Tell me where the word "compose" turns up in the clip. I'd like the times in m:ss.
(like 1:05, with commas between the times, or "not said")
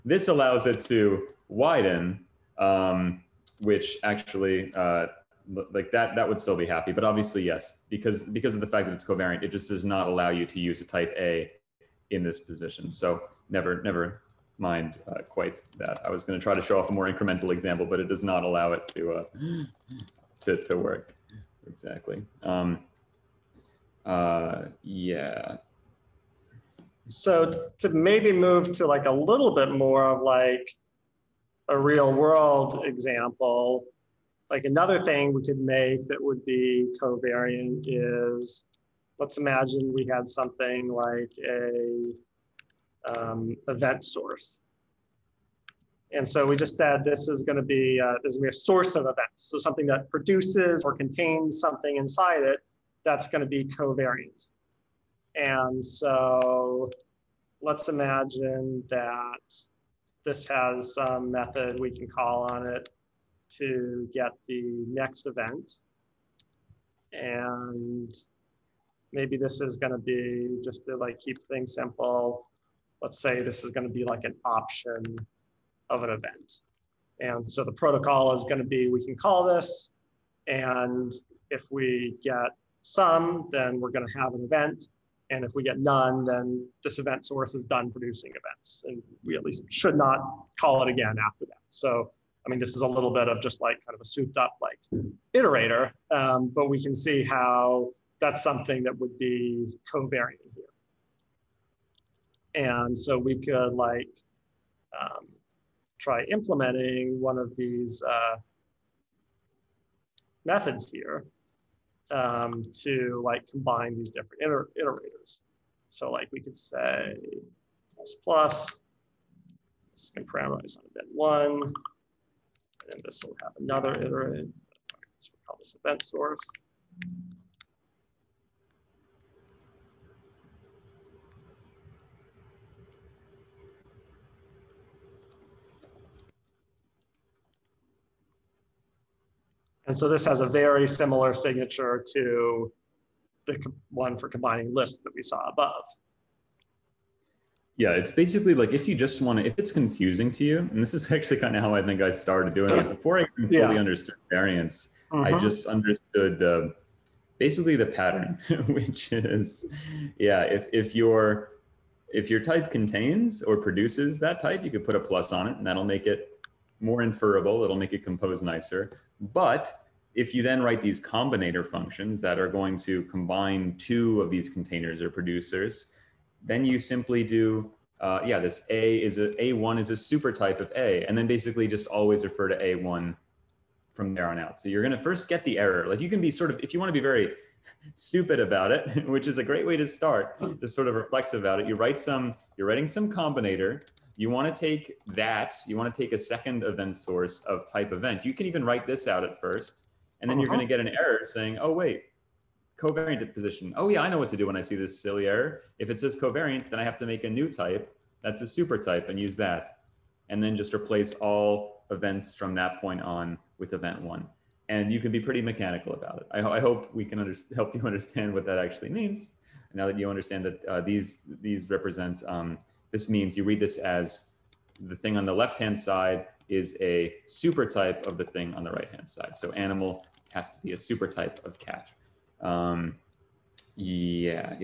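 2:48.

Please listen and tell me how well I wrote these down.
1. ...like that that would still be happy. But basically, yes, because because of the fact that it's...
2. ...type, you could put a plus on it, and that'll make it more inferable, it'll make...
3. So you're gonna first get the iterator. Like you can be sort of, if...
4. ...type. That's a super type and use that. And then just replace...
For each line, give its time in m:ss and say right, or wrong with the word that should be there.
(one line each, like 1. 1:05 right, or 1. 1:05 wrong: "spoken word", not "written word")
1. 0:05 wrong: "obviously", not "basically"
2. 2:44 right
3. 3:04 wrong: "error", not "iterator"
4. 3:27 right.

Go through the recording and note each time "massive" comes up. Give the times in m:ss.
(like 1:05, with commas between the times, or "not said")
not said.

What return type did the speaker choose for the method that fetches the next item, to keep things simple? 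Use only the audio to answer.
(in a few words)
Option of an event.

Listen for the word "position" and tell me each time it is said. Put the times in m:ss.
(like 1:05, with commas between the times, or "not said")
0:12, 3:23.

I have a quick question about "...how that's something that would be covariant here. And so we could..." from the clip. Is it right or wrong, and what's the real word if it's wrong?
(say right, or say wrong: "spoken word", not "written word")
right.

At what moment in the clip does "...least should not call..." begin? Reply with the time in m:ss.
1:29.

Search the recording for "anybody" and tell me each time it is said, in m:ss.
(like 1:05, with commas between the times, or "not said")
not said.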